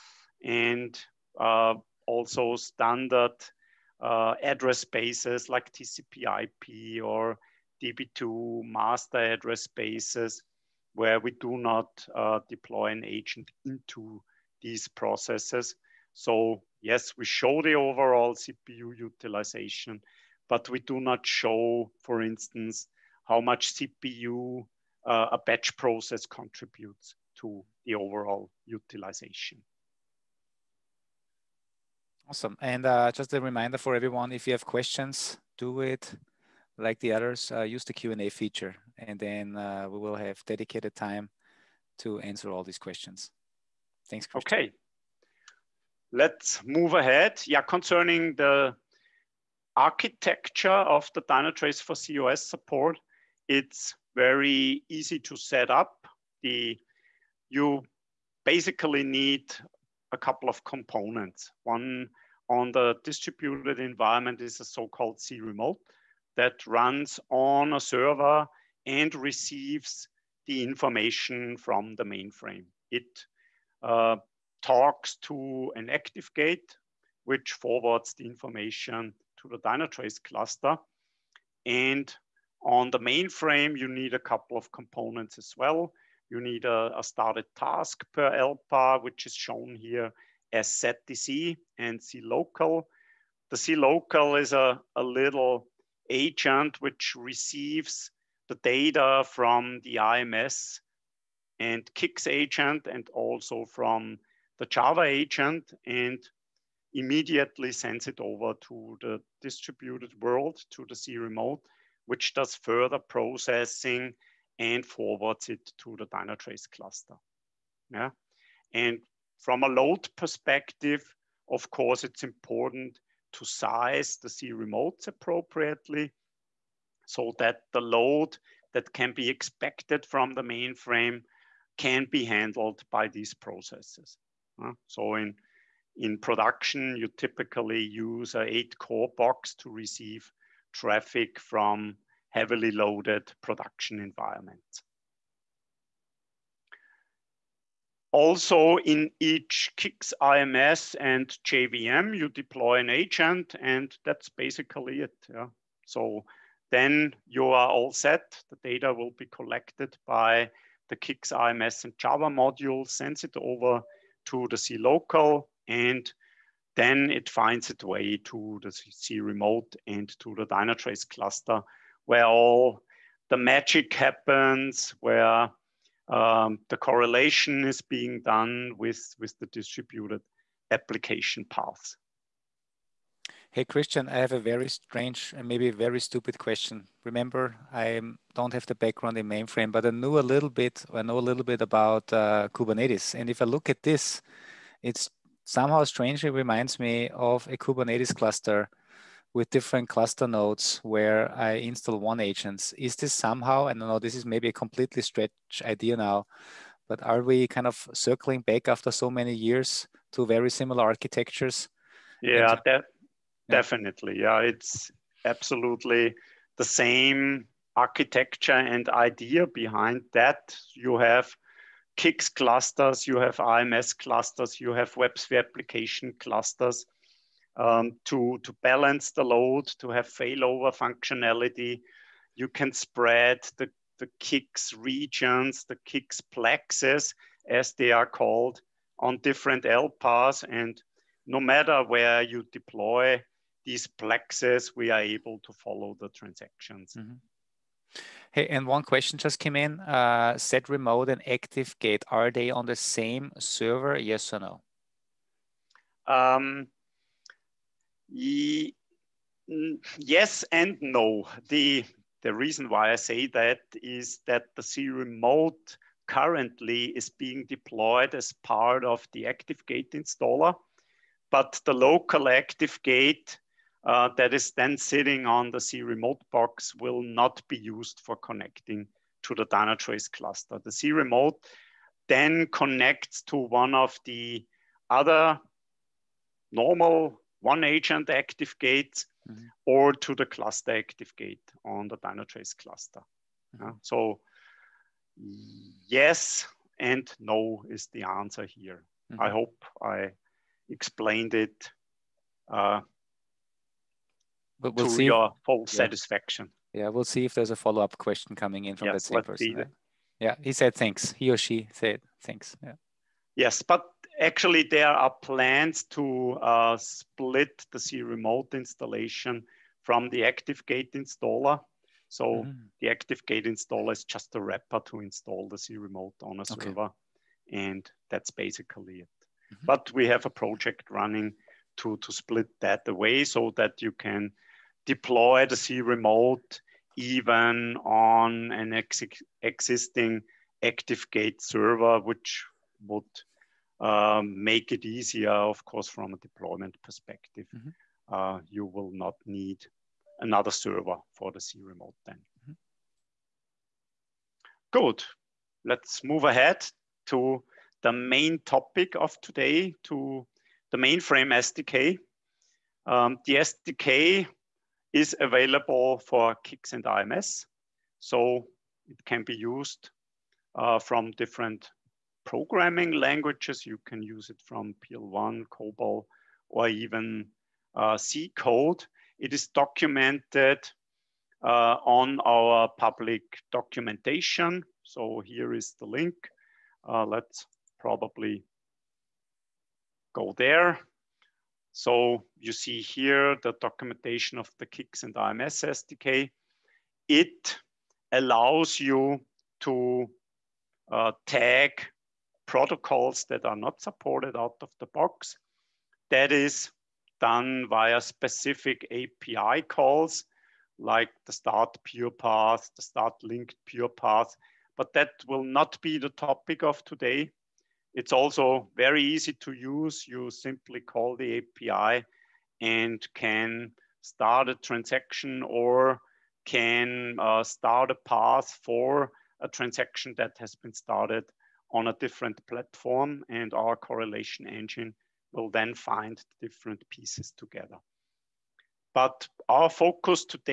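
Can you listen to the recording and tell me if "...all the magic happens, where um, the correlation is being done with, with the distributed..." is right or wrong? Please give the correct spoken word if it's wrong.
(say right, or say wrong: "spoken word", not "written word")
right.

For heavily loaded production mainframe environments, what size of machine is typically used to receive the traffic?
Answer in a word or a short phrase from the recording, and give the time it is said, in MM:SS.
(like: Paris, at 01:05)
8 core box, at 02:18.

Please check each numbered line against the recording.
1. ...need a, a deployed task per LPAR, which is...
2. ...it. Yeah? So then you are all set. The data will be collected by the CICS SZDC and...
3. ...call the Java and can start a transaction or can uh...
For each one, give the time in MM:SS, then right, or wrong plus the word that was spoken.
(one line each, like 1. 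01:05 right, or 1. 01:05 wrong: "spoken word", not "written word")
1. 01:26 wrong: "started", not "deployed"
2. 02:35 wrong: "IMS", not "SZDC"
3. 07:00 wrong: "API", not "Java".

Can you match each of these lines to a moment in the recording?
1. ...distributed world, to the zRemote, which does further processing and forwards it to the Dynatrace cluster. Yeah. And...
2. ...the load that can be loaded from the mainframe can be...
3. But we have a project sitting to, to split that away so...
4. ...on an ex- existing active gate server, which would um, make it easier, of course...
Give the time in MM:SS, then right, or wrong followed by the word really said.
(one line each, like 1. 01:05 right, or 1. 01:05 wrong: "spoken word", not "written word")
1. 01:49 right
2. 02:07 wrong: "expected", not "loaded"
3. 05:29 wrong: "running", not "sitting"
4. 05:37 right.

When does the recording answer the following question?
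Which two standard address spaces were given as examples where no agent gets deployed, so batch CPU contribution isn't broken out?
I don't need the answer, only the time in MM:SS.
00:05.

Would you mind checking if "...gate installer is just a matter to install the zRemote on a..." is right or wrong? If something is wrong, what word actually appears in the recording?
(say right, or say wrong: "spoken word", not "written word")
wrong: "wrapper", not "matter".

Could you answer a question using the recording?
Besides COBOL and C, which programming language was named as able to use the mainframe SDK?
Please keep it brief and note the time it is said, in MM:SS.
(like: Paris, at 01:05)
PL1, at 06:14.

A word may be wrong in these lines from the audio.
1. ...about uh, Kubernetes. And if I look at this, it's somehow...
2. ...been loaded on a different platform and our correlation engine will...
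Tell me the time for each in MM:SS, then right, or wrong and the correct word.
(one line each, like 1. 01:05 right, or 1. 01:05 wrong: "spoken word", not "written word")
1. 03:11 right
2. 07:10 wrong: "started", not "loaded".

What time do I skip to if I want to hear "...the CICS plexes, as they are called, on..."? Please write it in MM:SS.
03:55.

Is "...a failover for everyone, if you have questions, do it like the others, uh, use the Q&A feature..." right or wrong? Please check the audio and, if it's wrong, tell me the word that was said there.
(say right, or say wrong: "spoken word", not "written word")
wrong: "reminder", not "failover".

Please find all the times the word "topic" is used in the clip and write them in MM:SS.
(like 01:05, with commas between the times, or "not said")
05:58, 06:56.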